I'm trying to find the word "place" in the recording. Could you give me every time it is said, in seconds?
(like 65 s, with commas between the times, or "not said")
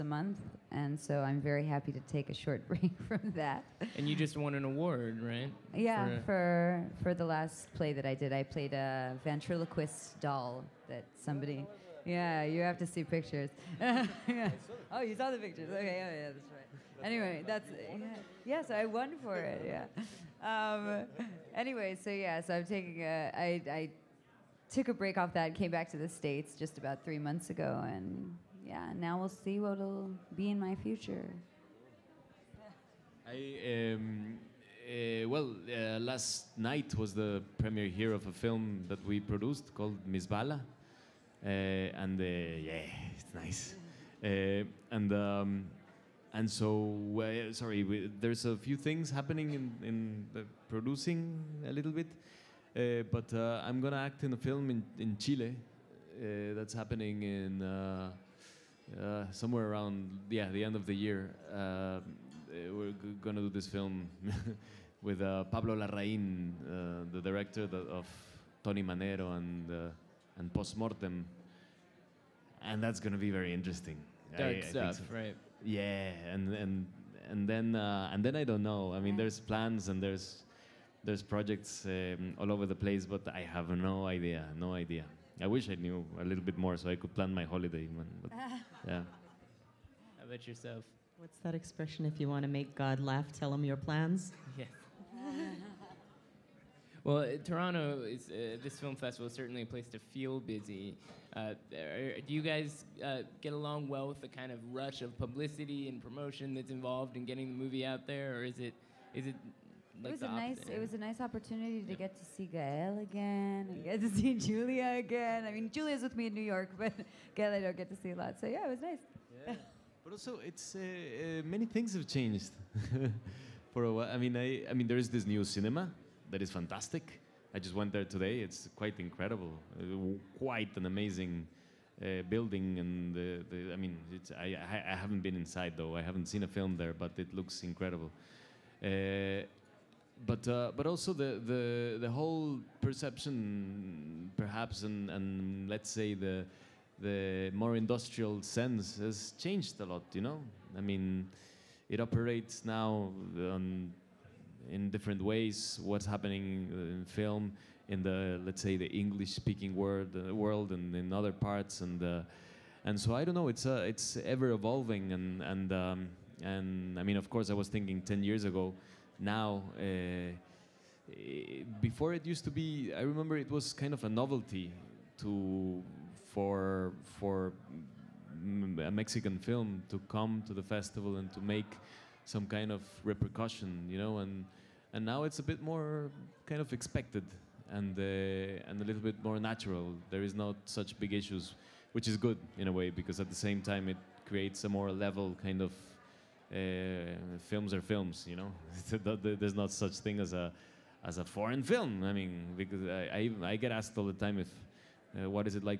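82 s, 99 s.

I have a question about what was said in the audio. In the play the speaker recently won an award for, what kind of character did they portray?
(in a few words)
ventriloquist doll.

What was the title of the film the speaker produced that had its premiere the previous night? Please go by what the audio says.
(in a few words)
Miss Bala.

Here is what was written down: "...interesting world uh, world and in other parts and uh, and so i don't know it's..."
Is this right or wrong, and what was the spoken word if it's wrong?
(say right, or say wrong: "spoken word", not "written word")
wrong: "speaking", not "interesting".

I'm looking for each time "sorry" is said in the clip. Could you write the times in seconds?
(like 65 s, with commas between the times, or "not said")
47 s.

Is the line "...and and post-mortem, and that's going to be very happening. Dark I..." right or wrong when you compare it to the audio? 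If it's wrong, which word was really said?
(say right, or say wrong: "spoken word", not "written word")
wrong: "interesting", not "happening".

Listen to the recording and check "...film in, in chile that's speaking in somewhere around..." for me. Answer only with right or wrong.
wrong.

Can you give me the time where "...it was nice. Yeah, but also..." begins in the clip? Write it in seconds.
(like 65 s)
118 s.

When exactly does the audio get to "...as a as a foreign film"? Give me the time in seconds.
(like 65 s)
200 s.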